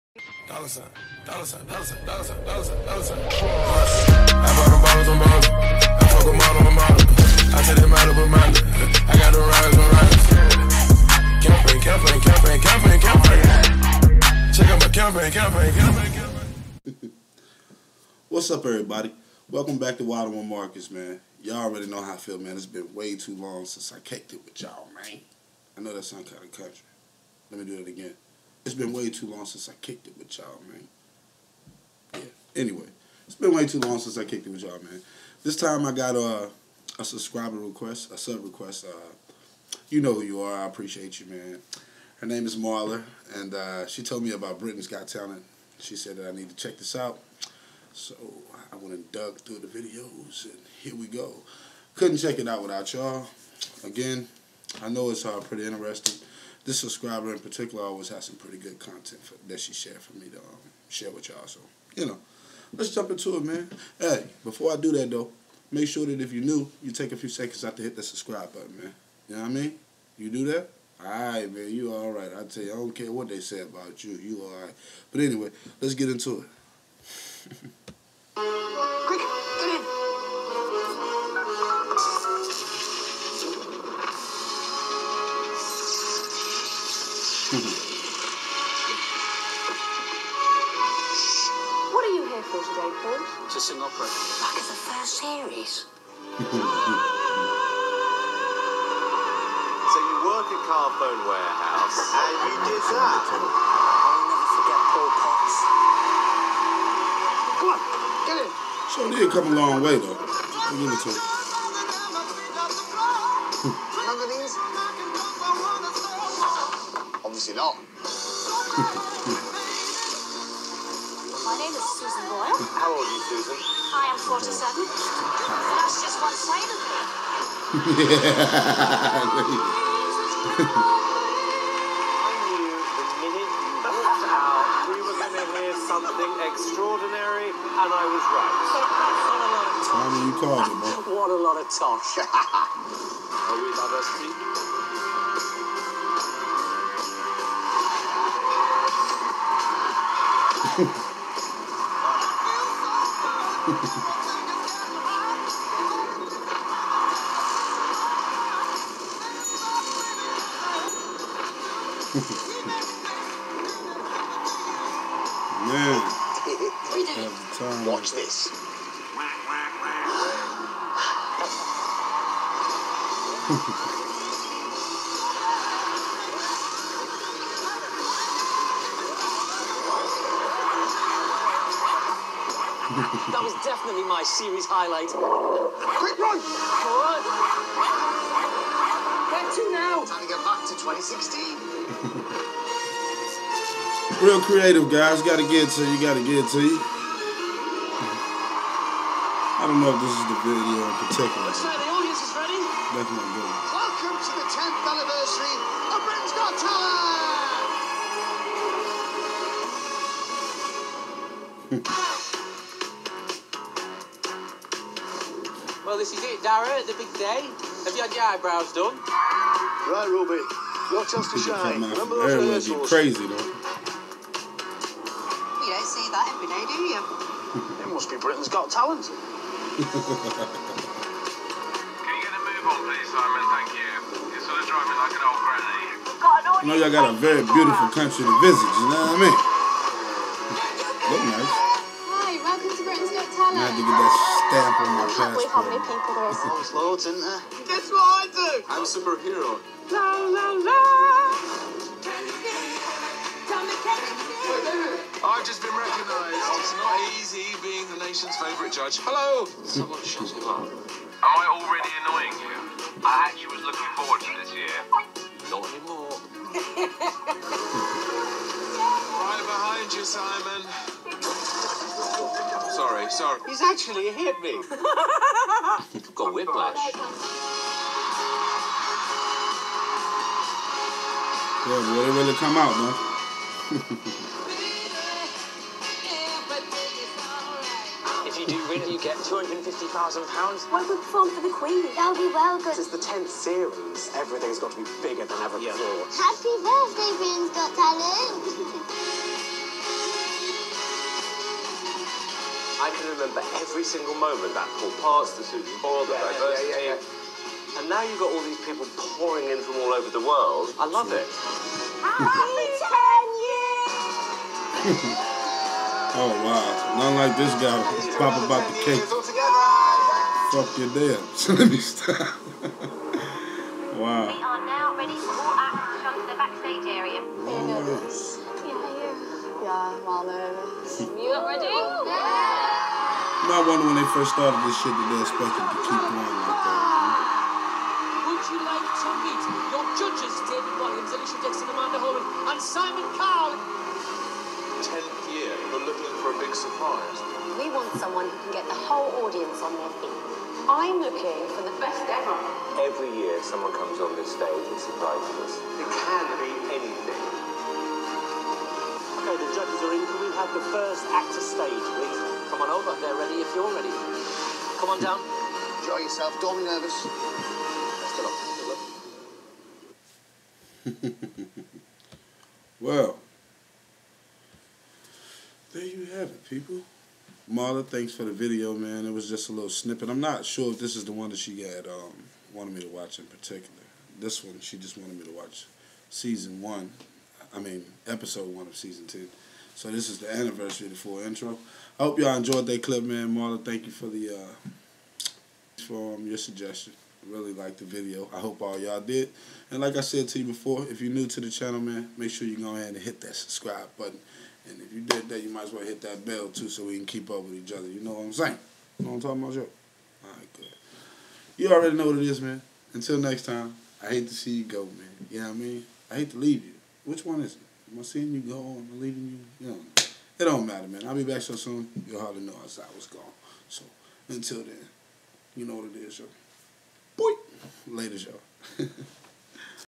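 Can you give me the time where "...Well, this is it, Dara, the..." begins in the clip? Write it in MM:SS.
03:35.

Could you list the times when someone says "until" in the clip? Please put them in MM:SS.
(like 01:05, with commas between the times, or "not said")
06:52, 07:04.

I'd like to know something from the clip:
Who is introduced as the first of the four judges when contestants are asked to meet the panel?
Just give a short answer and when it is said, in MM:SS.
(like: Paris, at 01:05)
David Walliams, at 05:40.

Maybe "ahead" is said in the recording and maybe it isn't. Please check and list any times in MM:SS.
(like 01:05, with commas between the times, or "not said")
06:42.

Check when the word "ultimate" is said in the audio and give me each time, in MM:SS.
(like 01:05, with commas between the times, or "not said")
not said.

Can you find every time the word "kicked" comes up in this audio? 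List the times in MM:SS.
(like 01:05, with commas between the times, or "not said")
00:23, 00:29, 00:34.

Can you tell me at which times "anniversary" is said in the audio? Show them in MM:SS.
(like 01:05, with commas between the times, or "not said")
03:24, 06:30.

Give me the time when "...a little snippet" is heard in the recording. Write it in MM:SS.
06:19.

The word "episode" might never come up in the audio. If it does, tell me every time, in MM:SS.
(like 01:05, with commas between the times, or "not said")
06:28.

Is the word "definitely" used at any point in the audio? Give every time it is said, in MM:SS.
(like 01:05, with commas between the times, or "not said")
03:03, 03:22.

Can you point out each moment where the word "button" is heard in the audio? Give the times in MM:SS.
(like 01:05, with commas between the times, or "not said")
01:08, 06:43.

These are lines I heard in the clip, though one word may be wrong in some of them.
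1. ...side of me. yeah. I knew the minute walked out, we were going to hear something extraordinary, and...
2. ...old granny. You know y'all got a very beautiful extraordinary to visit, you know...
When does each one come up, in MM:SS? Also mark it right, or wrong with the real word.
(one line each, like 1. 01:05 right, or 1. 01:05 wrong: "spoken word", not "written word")
1. 02:06 right
2. 03:55 wrong: "country", not "extraordinary".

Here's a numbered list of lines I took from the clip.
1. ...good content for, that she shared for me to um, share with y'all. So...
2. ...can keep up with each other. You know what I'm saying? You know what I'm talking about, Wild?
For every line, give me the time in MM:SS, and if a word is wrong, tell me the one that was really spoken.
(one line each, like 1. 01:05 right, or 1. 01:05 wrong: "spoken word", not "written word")
1. 00:58 right
2. 06:46 wrong: "Joe", not "Wild".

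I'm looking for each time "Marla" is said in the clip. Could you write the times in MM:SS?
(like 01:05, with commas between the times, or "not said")
00:42, 06:17, 06:33.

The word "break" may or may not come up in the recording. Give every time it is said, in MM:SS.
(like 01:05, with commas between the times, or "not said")
not said.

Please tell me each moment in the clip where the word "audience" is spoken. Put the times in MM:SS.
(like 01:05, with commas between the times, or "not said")
03:21, 05:49.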